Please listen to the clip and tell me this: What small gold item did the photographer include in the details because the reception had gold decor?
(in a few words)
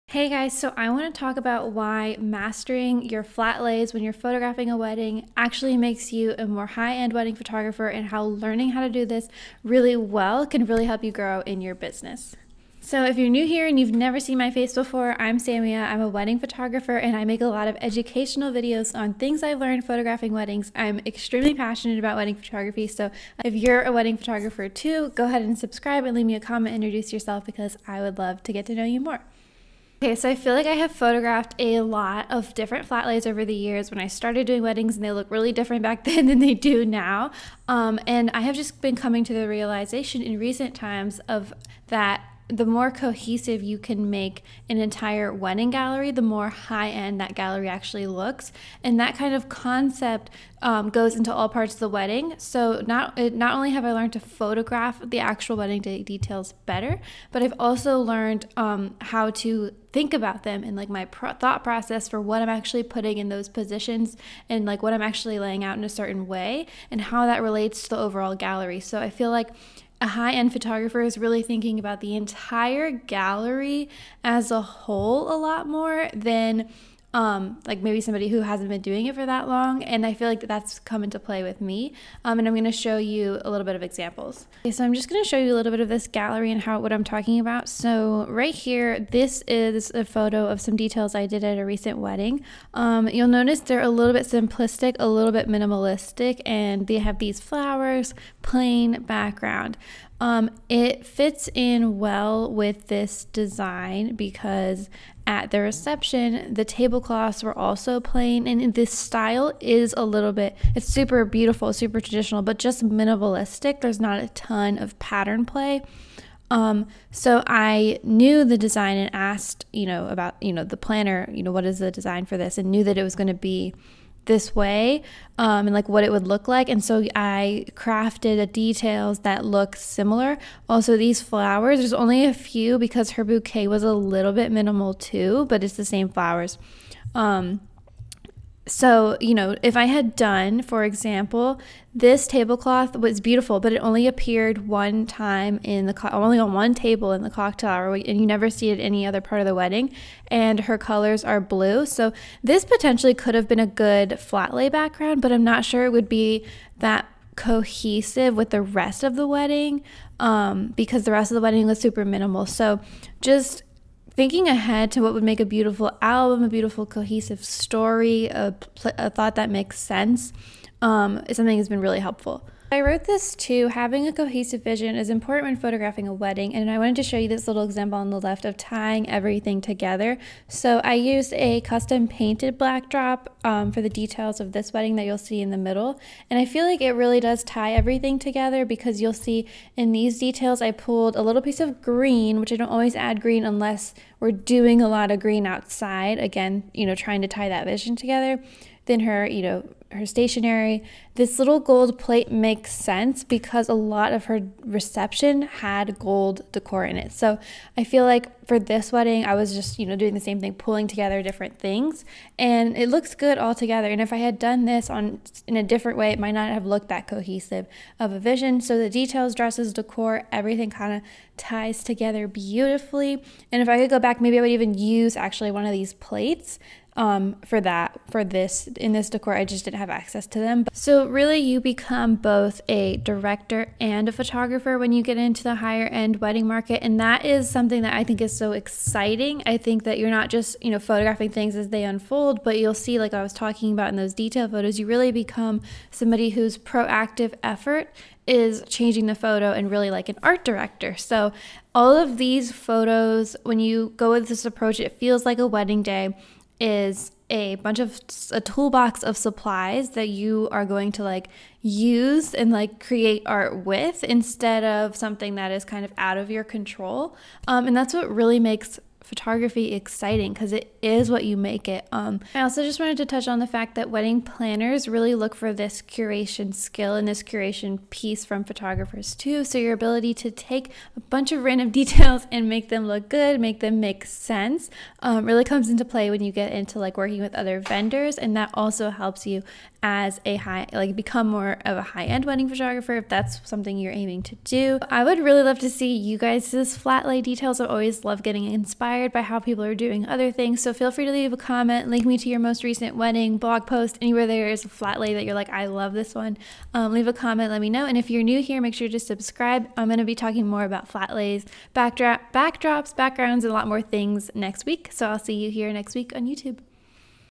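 Gold plate.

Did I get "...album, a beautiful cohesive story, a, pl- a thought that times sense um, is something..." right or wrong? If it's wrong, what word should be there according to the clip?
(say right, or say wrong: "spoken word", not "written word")
wrong: "makes", not "times".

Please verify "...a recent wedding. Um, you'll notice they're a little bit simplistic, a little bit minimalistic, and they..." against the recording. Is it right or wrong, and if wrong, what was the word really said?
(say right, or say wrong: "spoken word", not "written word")
right.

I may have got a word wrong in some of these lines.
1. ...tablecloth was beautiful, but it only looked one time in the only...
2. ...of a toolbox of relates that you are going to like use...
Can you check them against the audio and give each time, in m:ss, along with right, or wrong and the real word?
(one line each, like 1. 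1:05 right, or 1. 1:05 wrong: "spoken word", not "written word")
1. 2:22 wrong: "appeared", not "looked"
2. 4:17 wrong: "supplies", not "relates".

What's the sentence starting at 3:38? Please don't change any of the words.
So the details, dresses, decor, everything kind of ties together beautifully.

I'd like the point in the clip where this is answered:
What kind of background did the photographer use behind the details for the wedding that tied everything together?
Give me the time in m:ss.
3:01.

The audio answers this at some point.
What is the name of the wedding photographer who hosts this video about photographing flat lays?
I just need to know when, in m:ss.
0:15.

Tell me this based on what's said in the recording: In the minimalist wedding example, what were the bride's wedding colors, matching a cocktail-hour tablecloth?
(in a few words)
Blue.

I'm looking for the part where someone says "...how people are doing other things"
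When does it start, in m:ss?
4:59.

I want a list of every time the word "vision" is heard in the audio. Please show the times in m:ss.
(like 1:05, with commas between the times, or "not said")
2:54, 3:17, 3:38.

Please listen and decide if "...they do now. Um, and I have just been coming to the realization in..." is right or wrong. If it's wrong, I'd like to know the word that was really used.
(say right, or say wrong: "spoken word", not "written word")
right.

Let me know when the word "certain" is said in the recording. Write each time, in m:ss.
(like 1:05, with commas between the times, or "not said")
1:05.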